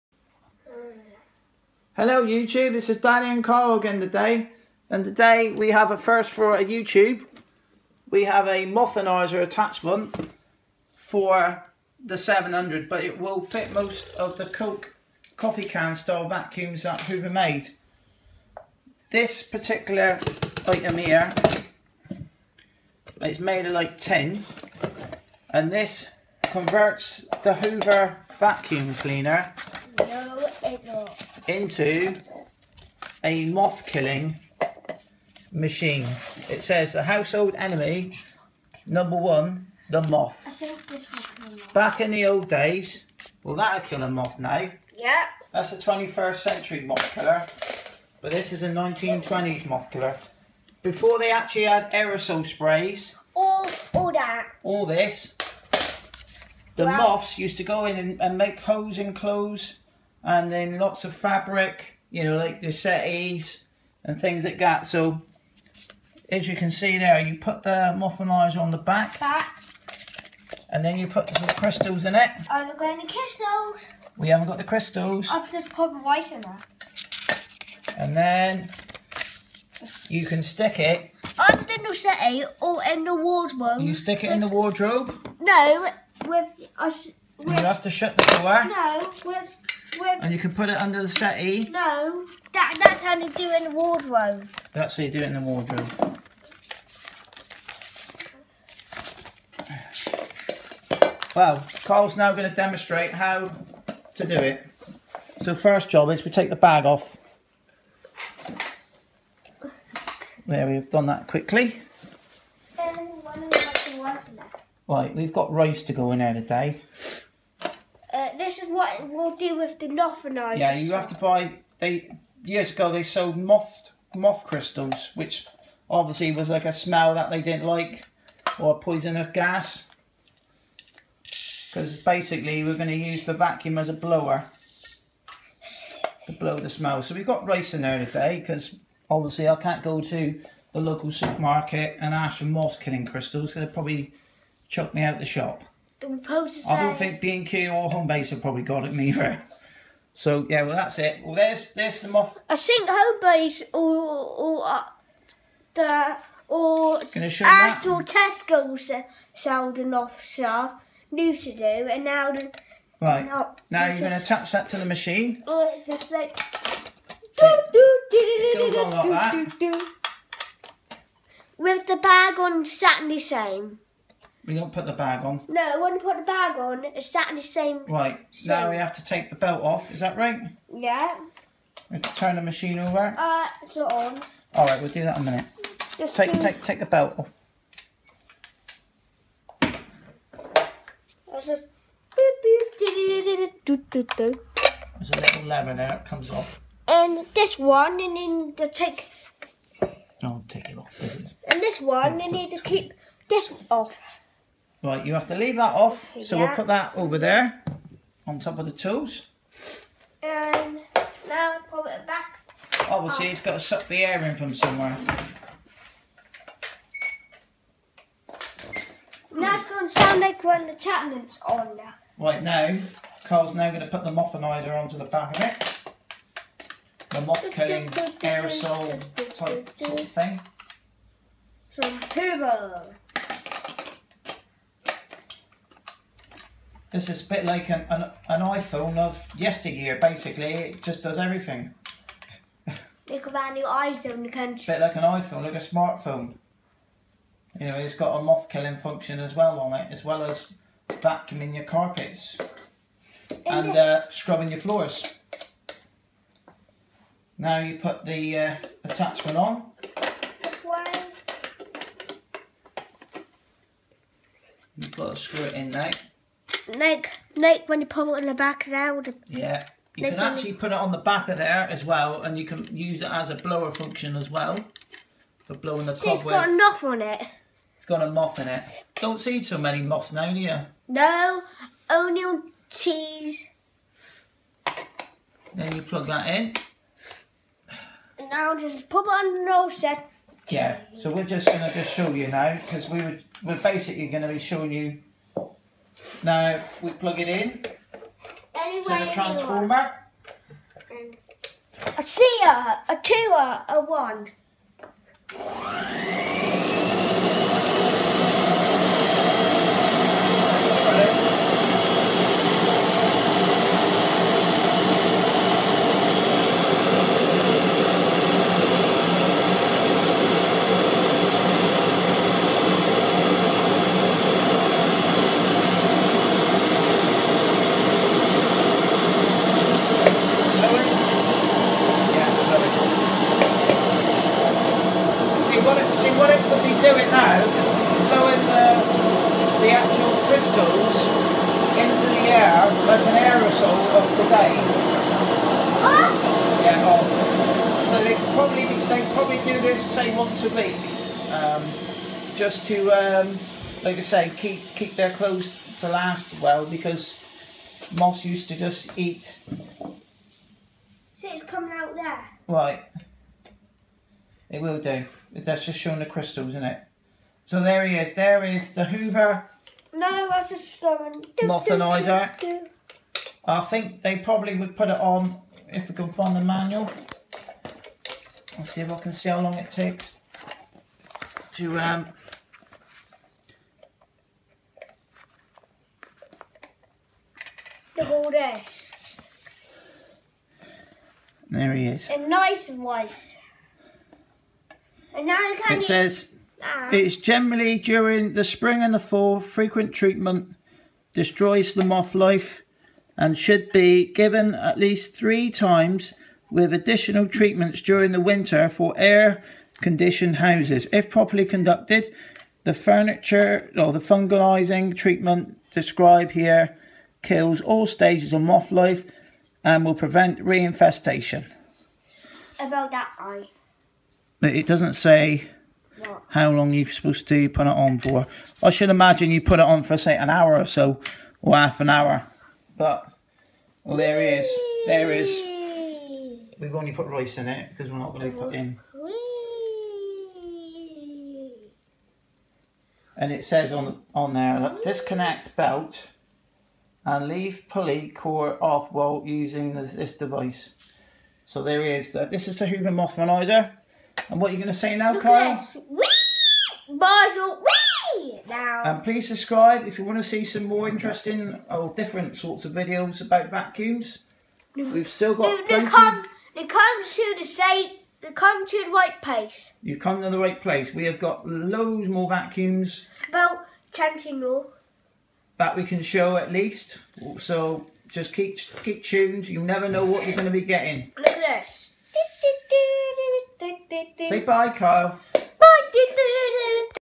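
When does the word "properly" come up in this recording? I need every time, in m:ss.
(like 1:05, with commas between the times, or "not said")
6:51.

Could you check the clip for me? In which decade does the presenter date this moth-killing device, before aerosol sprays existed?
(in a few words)
1920s.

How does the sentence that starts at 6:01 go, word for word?
See, so it's coming out there.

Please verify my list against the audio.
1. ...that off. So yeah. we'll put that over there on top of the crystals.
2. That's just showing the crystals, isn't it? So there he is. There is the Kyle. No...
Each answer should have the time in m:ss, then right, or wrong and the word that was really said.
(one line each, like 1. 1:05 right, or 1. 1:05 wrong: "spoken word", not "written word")
1. 3:25 wrong: "tools", not "crystals"
2. 6:05 wrong: "Hoover", not "Kyle".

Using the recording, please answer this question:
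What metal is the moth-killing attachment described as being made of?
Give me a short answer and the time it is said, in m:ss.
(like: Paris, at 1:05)
Tin, at 0:23.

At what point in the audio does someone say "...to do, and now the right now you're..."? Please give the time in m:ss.
2:41.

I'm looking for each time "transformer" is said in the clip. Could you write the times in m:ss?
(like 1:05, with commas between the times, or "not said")
4:59.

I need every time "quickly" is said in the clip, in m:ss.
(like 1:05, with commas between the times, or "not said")
1:51.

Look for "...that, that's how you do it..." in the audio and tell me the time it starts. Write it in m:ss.
1:32.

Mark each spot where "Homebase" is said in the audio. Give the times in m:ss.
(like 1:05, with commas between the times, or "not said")
2:27, 2:32.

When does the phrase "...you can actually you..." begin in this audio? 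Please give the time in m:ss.
4:29.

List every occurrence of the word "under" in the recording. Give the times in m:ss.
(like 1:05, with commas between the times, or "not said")
1:21, 1:30.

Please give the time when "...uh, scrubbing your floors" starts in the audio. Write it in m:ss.
4:13.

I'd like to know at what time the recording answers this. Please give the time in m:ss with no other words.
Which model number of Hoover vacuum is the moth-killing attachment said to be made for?
0:12.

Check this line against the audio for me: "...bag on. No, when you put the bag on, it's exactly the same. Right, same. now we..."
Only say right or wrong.
right.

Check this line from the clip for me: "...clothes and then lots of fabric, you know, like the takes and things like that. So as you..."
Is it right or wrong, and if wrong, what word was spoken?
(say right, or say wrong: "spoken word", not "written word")
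wrong: "settees", not "takes".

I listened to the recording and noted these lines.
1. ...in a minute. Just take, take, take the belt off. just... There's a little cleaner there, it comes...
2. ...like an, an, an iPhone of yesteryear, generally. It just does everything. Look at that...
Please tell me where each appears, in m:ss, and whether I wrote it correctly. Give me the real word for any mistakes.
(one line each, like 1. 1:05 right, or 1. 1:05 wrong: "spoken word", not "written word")
1. 3:05 wrong: "lever", not "cleaner"
2. 3:57 wrong: "basically", not "generally".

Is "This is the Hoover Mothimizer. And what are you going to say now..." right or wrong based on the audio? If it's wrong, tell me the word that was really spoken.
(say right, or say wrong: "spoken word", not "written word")
right.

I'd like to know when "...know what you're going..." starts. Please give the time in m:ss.
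7:59.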